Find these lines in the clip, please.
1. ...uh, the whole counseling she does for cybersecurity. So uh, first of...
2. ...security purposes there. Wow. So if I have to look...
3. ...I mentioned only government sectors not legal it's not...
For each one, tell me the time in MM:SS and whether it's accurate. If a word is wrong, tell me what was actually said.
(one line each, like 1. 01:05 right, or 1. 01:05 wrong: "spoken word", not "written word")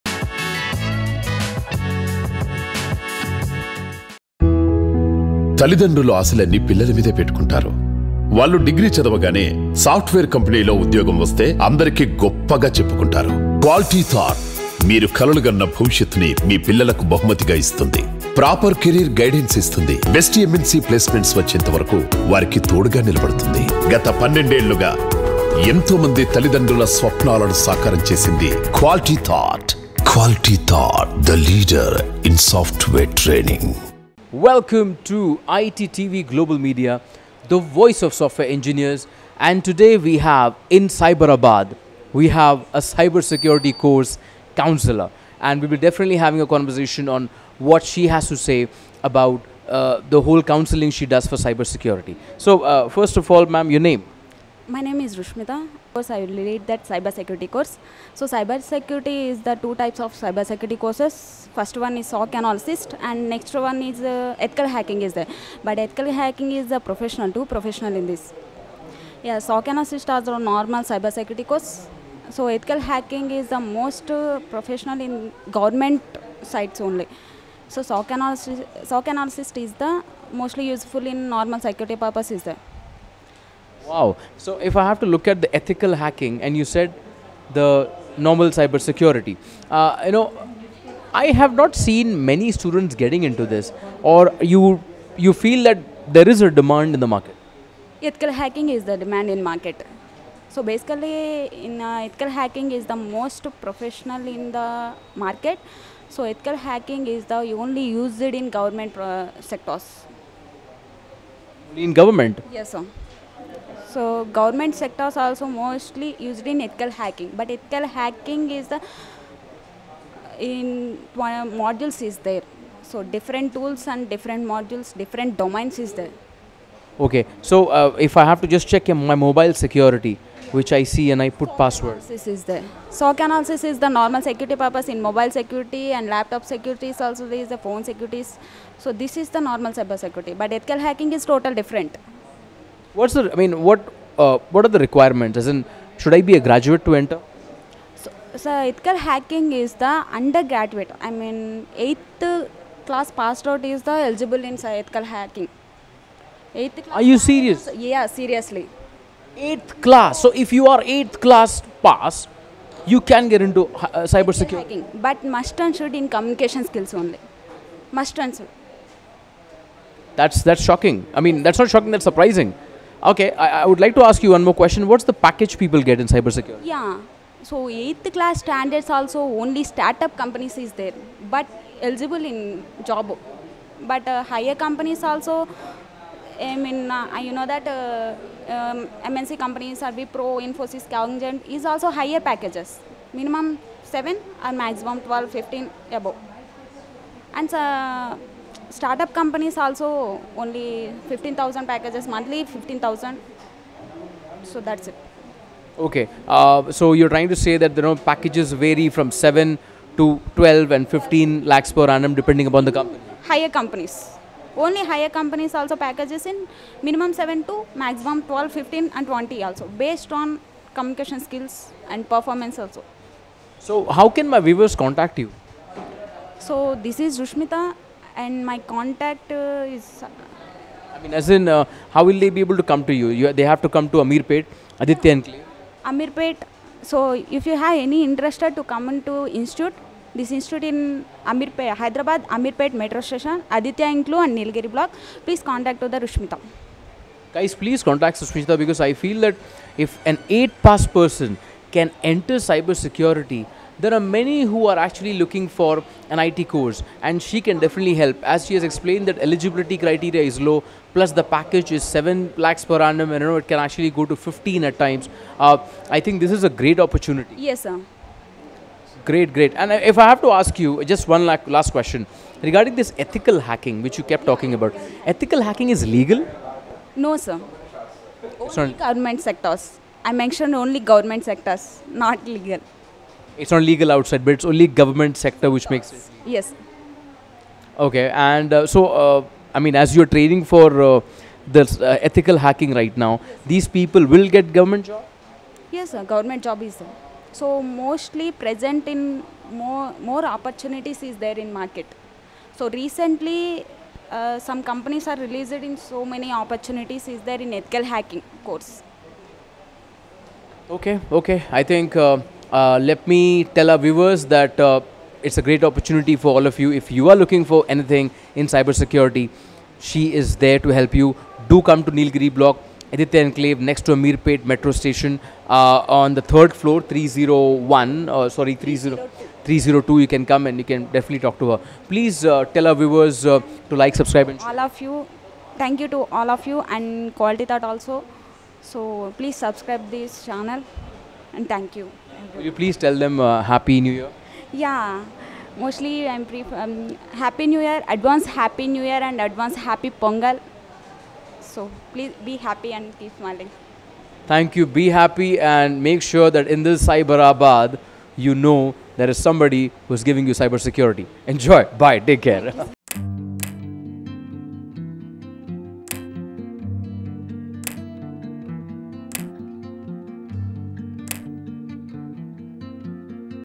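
1. 00:49 right
2. 01:21 right
3. 04:40 right.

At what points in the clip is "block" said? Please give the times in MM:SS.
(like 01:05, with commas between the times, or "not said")
04:04, 05:22.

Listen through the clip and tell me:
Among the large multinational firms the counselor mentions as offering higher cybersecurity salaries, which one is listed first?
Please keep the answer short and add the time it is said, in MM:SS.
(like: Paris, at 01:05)
Wipro, at 03:09.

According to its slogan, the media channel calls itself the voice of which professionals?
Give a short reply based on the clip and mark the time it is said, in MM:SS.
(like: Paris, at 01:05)
software engineers, at 00:38.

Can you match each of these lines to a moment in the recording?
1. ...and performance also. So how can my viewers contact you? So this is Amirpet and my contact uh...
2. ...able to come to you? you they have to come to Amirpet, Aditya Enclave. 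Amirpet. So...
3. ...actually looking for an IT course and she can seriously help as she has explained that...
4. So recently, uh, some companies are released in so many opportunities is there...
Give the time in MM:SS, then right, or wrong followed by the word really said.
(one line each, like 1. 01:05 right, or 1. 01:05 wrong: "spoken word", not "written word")
1. 03:41 wrong: "Rushmita", not "Amirpet"
2. 03:52 right
3. 04:14 wrong: "definitely", not "seriously"
4. 05:02 right.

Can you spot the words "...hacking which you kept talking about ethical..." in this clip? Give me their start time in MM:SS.
04:33.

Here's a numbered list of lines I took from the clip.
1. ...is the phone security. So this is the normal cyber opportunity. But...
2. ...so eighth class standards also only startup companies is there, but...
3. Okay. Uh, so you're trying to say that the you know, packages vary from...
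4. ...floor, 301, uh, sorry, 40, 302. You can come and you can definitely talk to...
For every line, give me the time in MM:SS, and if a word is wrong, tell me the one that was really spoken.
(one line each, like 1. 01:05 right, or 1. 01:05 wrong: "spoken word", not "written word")
1. 02:17 wrong: "security", not "opportunity"
2. 02:57 right
3. 03:25 right
4. 05:26 wrong: "30", not "40".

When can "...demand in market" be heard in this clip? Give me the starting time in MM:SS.
01:38.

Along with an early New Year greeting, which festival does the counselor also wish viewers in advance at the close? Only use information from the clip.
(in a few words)
Pongal.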